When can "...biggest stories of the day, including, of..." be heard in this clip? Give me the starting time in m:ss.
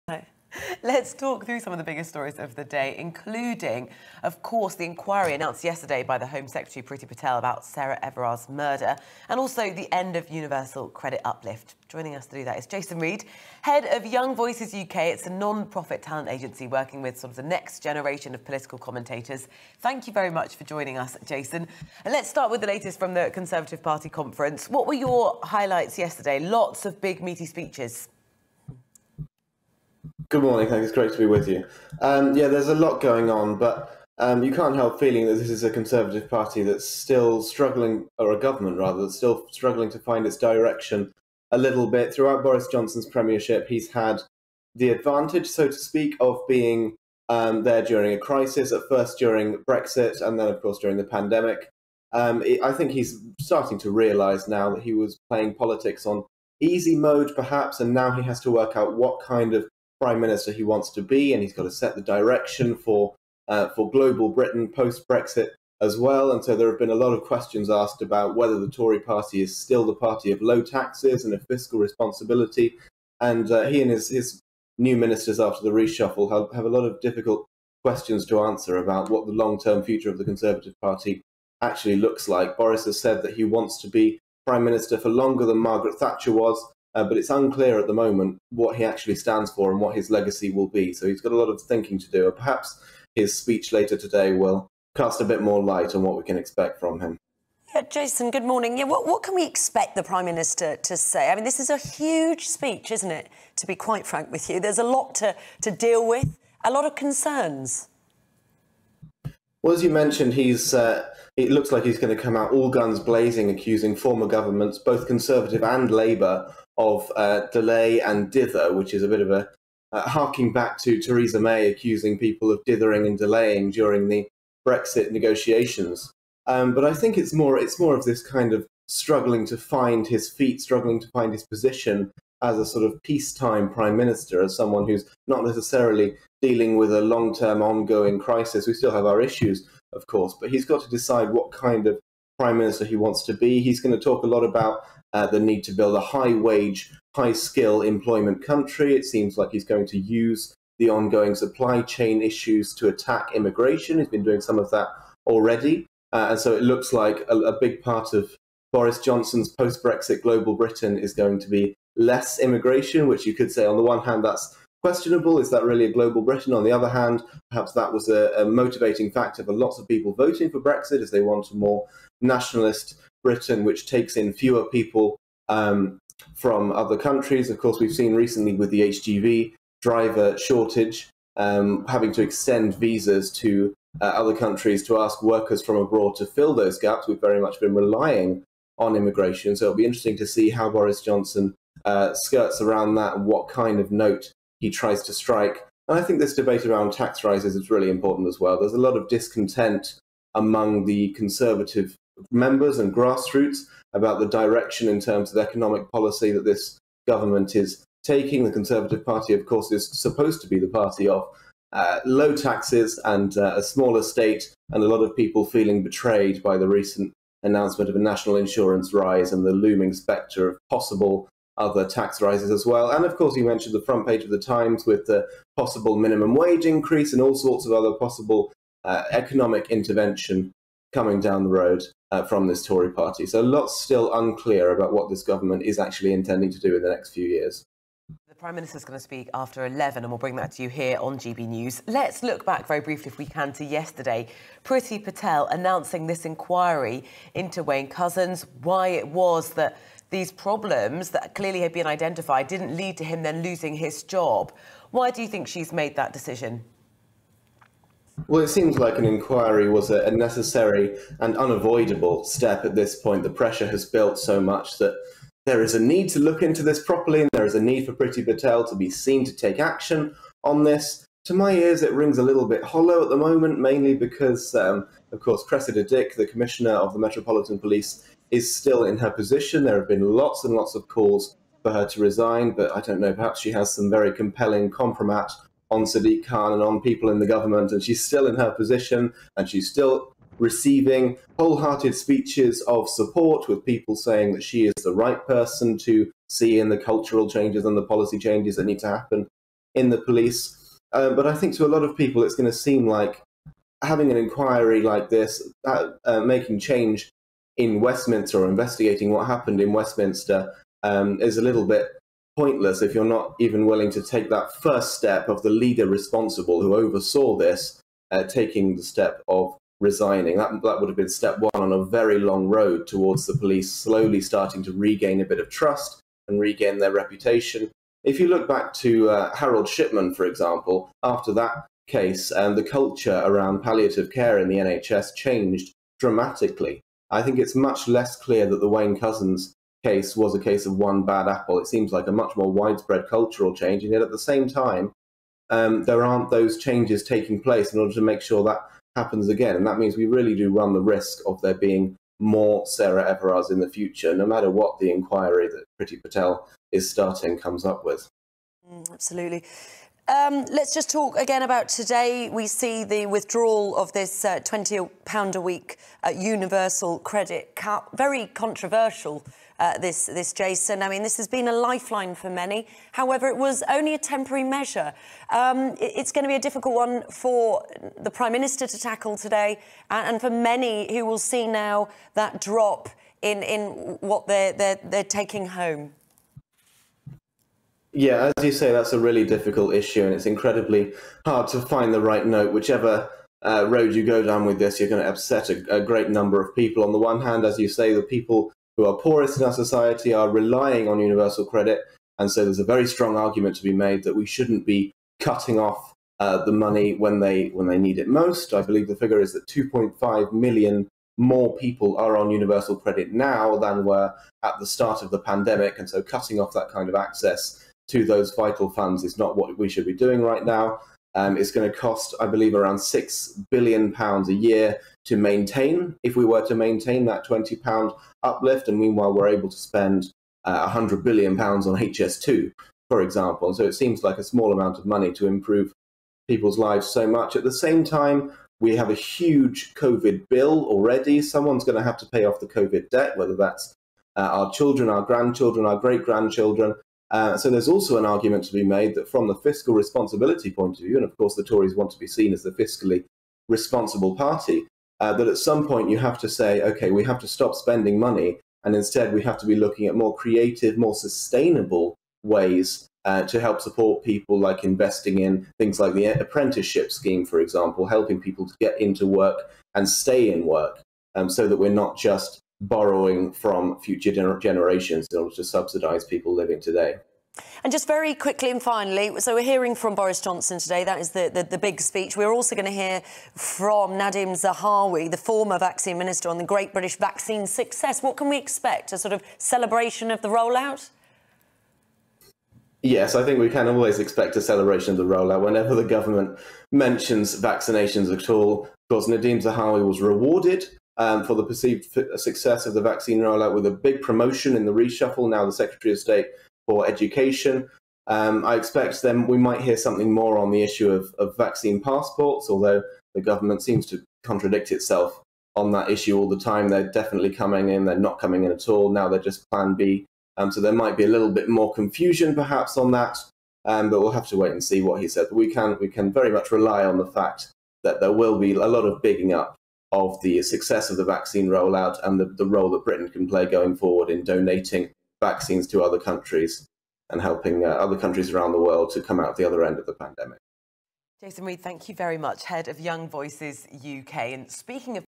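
0:01.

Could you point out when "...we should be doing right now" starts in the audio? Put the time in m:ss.
6:59.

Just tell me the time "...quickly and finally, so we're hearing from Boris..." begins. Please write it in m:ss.
7:58.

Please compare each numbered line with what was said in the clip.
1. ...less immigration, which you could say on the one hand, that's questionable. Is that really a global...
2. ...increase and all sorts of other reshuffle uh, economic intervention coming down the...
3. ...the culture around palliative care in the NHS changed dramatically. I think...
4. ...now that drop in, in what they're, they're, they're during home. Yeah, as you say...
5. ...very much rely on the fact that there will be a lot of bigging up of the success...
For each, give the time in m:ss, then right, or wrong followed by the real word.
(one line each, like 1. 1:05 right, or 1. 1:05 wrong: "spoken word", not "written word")
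1. 2:41 right
2. 3:46 wrong: "possible", not "reshuffle"
3. 5:32 right
4. 6:21 wrong: "taking", not "during"
5. 8:46 right.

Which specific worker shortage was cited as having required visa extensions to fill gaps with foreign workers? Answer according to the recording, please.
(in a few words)
HGV driver shortage.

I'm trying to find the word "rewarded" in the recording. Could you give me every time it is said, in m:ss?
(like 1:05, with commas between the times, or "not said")
8:20.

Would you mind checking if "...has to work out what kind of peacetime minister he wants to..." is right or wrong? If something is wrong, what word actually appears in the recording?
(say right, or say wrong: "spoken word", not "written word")
wrong: "prime", not "peacetime".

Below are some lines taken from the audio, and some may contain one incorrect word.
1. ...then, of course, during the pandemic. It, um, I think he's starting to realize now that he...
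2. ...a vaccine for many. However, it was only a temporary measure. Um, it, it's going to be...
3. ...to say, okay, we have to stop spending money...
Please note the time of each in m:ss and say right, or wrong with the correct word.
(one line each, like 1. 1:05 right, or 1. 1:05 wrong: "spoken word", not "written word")
1. 0:50 right
2. 6:11 wrong: "lifeline", not "vaccine"
3. 7:36 right.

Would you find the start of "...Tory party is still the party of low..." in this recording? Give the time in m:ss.
1:08.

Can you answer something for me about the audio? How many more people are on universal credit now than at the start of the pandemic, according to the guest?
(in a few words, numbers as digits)
2.5 million.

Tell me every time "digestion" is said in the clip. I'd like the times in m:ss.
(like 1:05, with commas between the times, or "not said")
not said.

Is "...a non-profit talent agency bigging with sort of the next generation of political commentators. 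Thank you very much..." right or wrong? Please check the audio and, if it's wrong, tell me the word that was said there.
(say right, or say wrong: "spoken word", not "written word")
wrong: "working", not "bigging".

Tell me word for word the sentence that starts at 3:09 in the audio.
So it'll be interesting to see how Boris Johnson uh, skirts around that and what kind of note he tries to strike.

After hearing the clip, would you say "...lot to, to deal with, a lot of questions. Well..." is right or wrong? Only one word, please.
wrong.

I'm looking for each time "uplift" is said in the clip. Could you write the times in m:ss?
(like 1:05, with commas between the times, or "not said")
0:11, 7:08.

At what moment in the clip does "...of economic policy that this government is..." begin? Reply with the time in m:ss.
3:25.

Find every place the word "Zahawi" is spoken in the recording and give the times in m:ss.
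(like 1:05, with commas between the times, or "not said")
8:04, 8:19.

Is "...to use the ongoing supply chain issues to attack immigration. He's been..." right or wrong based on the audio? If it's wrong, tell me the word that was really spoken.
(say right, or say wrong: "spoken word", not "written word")
right.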